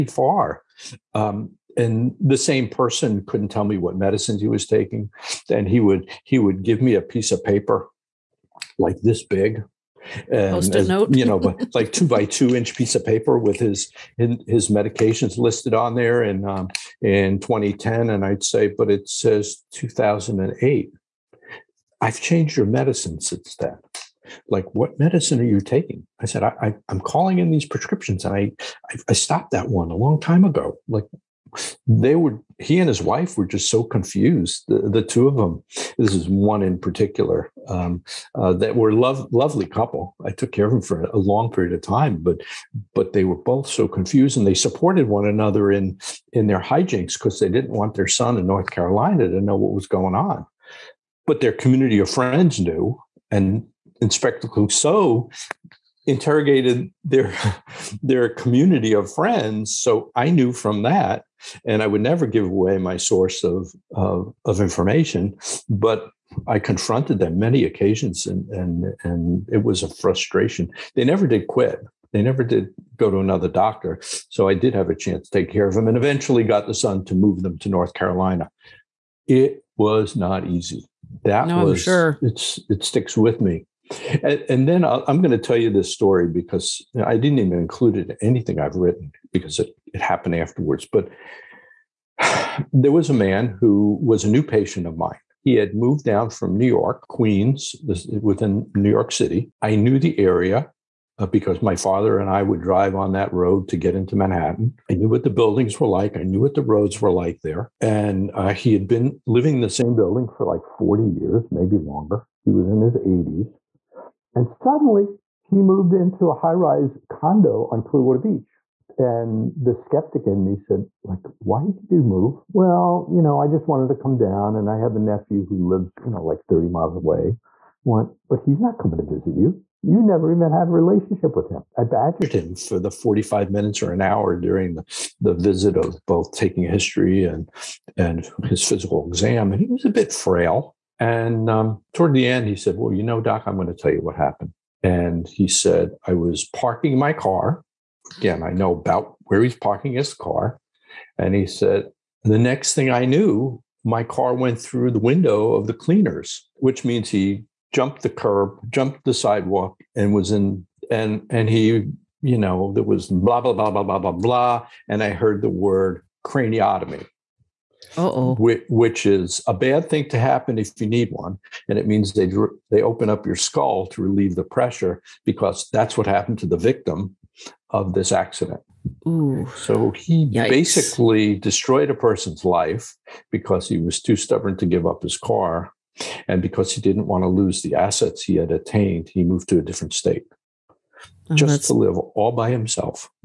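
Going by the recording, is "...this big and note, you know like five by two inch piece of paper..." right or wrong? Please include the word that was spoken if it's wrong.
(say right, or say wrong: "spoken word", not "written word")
wrong: "two", not "five".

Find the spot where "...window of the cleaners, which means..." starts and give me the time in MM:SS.
02:34.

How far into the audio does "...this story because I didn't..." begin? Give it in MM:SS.
01:25.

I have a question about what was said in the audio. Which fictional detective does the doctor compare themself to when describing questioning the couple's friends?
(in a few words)
Inspector Clouseau.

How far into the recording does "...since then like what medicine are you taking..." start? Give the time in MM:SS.
00:23.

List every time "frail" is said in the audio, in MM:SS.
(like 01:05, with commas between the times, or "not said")
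02:20.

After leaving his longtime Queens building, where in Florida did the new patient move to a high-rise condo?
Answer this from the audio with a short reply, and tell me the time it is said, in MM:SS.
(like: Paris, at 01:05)
Clearwater Beach, at 01:57.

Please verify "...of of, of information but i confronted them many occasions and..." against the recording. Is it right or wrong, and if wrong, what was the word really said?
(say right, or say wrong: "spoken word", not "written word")
right.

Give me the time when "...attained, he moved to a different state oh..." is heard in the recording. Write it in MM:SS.
03:08.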